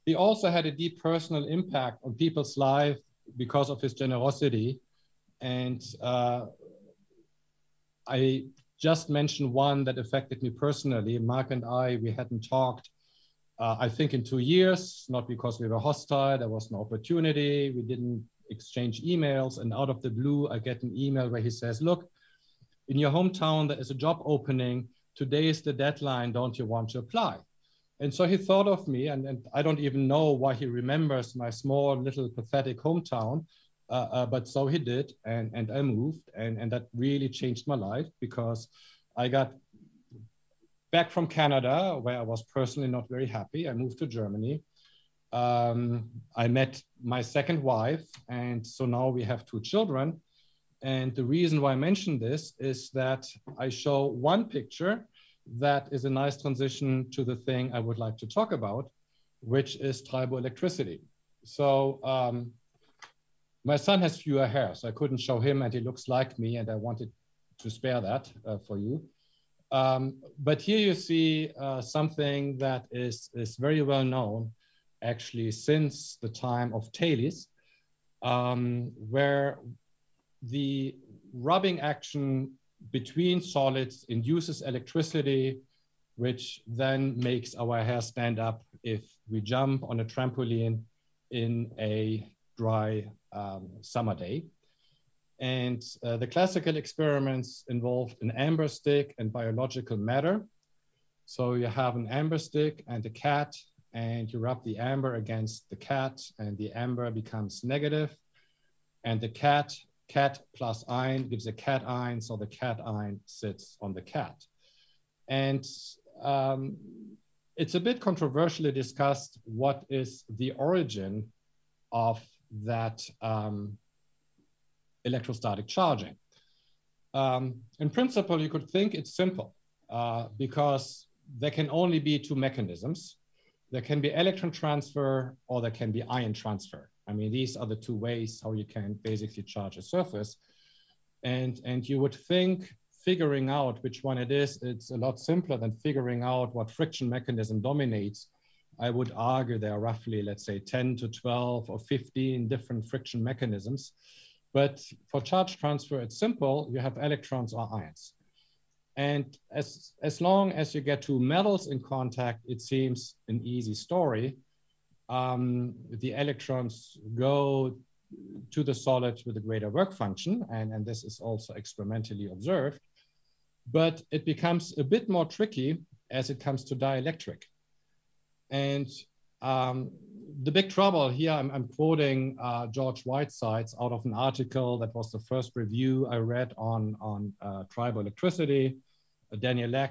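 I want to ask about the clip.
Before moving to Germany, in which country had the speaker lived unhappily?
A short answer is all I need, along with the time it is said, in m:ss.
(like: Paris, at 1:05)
Canada, at 0:41.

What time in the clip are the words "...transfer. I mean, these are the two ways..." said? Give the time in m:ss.
2:16.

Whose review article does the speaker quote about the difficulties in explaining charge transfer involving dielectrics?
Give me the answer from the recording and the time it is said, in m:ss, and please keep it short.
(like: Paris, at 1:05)
George Whitesides, at 3:02.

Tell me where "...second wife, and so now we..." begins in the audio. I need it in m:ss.
0:47.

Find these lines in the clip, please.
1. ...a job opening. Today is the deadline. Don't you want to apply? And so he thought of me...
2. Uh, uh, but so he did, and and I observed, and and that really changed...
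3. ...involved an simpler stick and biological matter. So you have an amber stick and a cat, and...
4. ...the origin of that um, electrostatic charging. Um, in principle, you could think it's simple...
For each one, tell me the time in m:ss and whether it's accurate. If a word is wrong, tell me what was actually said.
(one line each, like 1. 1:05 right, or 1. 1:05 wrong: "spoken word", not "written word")
1. 0:23 right
2. 0:33 wrong: "moved", not "observed"
3. 1:37 wrong: "amber", not "simpler"
4. 2:00 right.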